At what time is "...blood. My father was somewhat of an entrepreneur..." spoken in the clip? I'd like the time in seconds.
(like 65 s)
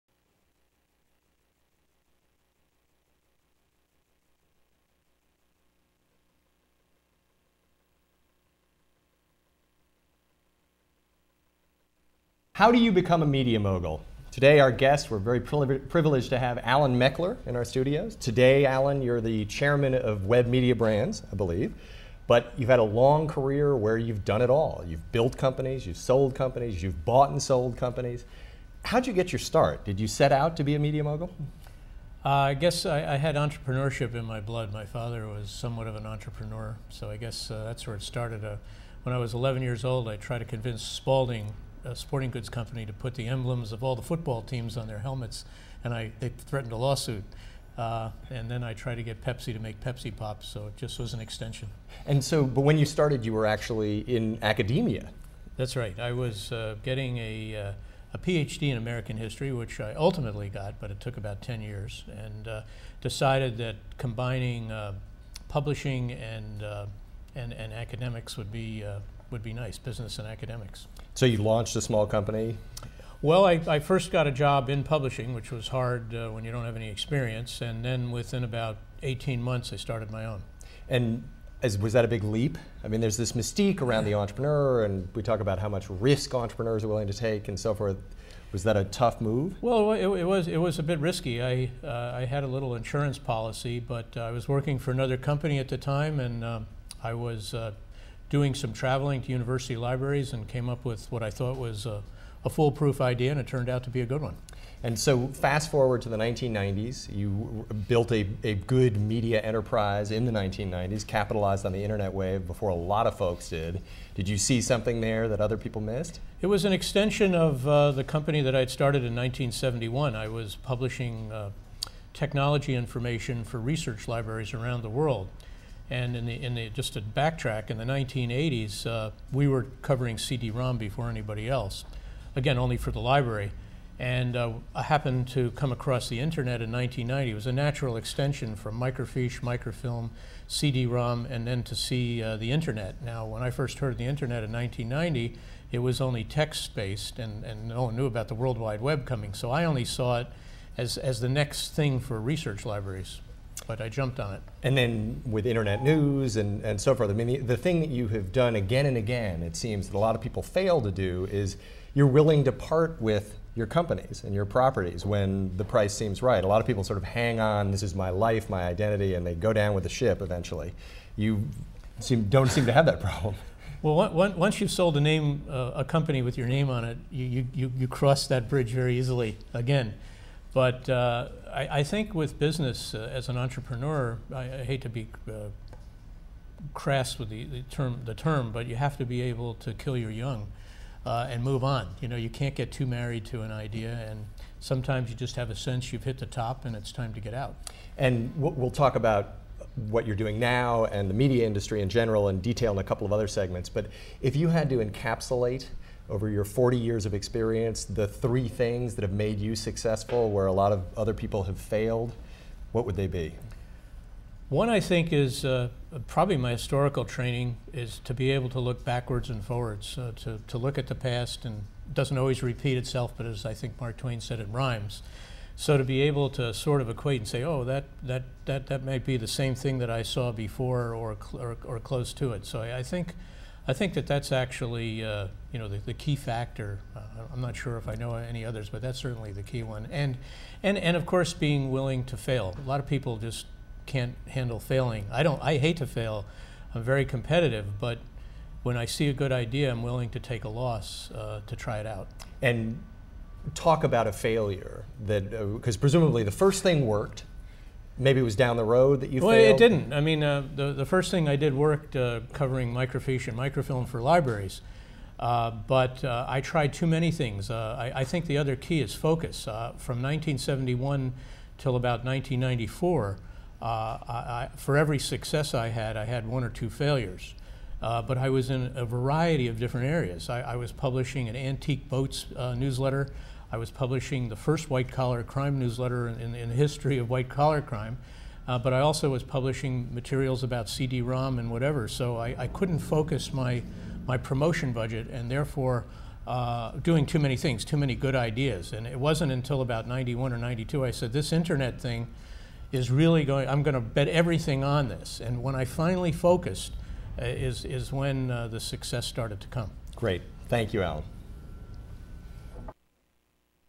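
34 s.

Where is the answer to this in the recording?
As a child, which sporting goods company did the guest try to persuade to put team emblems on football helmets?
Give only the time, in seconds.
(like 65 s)
40 s.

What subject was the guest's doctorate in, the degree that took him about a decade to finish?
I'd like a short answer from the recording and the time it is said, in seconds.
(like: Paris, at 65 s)
American history, at 58 s.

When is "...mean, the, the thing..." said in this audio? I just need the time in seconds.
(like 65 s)
157 s.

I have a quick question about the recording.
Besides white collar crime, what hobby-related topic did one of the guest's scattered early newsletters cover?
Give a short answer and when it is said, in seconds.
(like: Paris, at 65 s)
Antique boats, at 281 s.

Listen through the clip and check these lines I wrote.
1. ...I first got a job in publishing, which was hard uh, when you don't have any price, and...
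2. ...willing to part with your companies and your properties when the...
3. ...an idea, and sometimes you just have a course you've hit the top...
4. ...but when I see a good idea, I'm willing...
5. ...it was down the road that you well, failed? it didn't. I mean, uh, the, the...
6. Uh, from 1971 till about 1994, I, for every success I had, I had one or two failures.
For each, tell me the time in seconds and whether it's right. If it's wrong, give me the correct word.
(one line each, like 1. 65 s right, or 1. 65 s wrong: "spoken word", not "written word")
1. 73 s wrong: "experience", not "price"
2. 162 s right
3. 193 s wrong: "sense", not "course"
4. 247 s right
5. 258 s right
6. 269 s right.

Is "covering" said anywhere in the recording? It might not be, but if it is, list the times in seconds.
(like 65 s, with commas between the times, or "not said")
129 s, 262 s.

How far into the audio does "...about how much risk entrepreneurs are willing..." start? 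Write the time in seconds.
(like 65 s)
85 s.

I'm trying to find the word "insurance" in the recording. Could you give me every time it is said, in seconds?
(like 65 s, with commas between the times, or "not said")
92 s.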